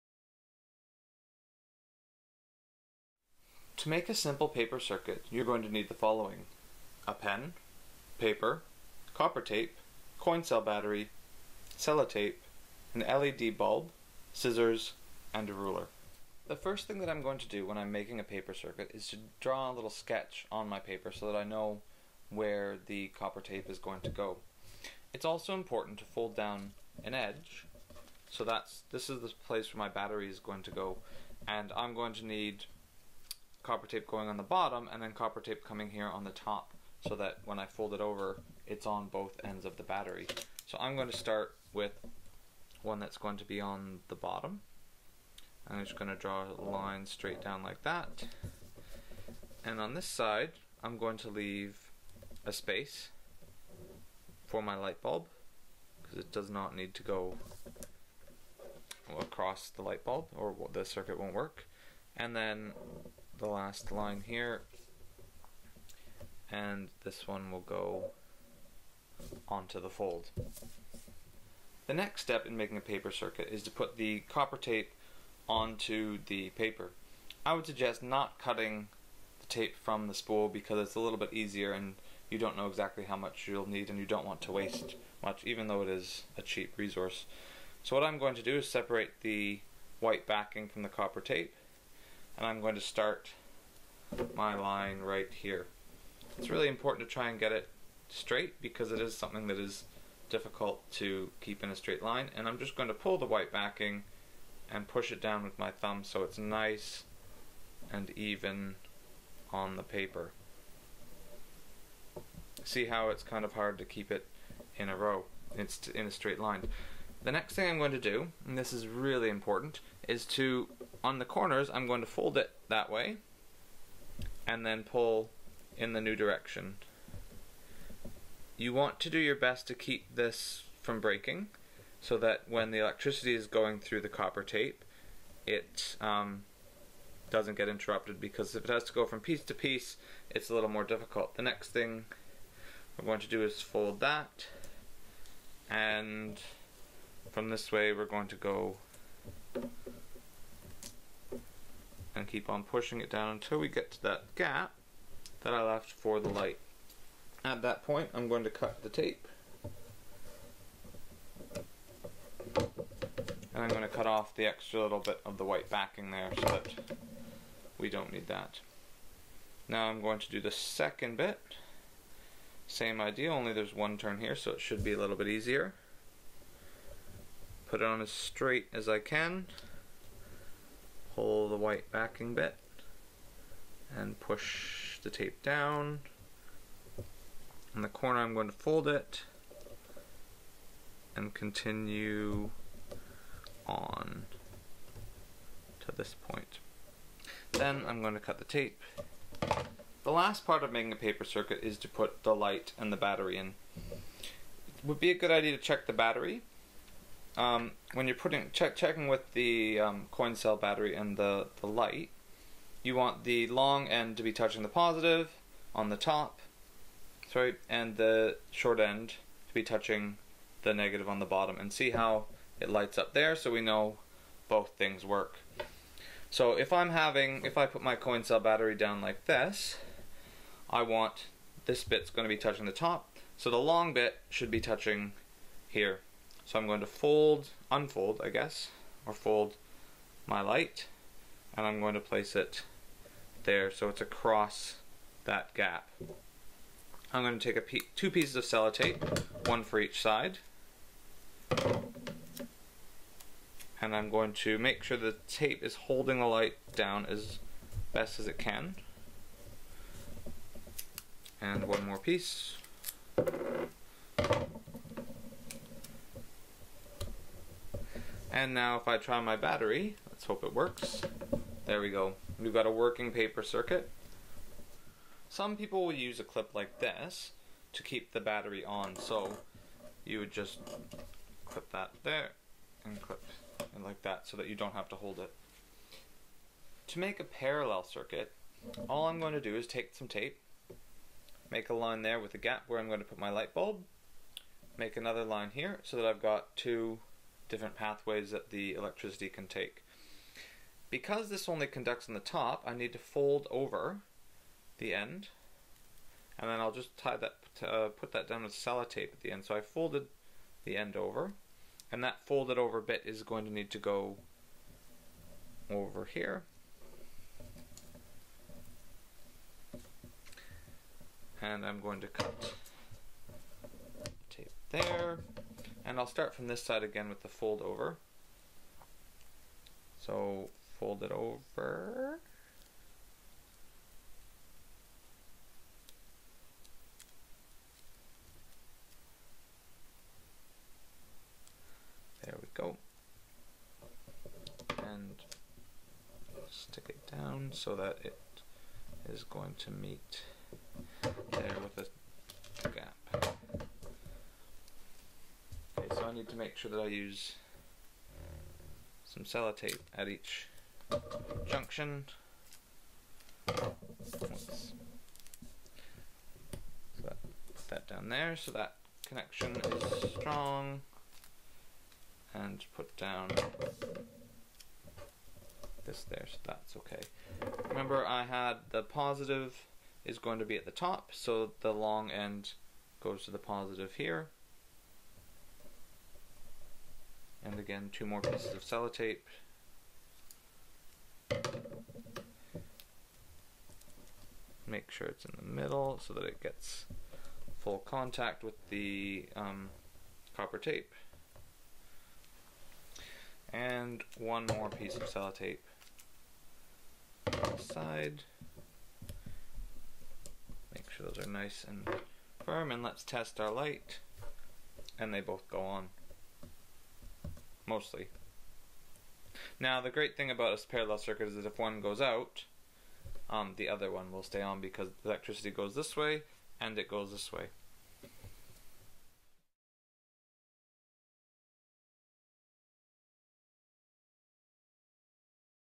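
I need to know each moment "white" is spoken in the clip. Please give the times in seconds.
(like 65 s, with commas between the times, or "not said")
89 s, 103 s, 165 s, 181 s.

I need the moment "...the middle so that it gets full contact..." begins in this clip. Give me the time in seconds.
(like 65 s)
395 s.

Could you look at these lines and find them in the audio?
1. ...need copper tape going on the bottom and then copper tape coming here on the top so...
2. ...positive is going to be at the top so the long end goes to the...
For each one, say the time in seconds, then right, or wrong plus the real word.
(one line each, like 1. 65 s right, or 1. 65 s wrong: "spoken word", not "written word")
1. 32 s right
2. 378 s right.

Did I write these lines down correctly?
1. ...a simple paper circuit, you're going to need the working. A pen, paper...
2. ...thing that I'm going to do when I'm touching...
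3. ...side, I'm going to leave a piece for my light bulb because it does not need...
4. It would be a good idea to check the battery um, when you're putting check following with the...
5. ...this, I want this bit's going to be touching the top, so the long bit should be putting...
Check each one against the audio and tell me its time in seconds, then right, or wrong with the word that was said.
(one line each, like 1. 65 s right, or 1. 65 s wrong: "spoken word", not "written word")
1. 4 s wrong: "following", not "working"
2. 16 s wrong: "making", not "touching"
3. 50 s wrong: "space", not "piece"
4. 203 s wrong: "checking", not "following"
5. 229 s wrong: "touching", not "putting".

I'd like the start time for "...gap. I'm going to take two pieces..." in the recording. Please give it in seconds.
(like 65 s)
245 s.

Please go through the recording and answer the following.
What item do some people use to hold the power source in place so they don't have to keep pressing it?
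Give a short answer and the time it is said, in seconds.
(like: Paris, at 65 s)
A clip, at 276 s.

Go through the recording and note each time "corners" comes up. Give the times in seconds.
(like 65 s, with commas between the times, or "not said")
121 s, 187 s.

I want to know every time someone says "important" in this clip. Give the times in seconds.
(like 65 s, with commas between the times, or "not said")
25 s, 96 s, 119 s.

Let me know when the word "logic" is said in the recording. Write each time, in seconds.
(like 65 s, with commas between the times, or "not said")
not said.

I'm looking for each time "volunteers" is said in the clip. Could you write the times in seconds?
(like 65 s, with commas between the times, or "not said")
not said.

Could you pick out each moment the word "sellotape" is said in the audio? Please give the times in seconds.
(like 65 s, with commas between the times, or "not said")
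11 s, 248 s, 308 s, 359 s, 388 s, 405 s.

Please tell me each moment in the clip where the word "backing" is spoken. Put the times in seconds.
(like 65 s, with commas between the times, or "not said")
90 s, 103 s, 165 s, 181 s.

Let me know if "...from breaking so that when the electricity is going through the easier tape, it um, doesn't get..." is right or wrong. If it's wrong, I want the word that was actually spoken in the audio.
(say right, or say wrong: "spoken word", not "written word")
wrong: "copper", not "easier".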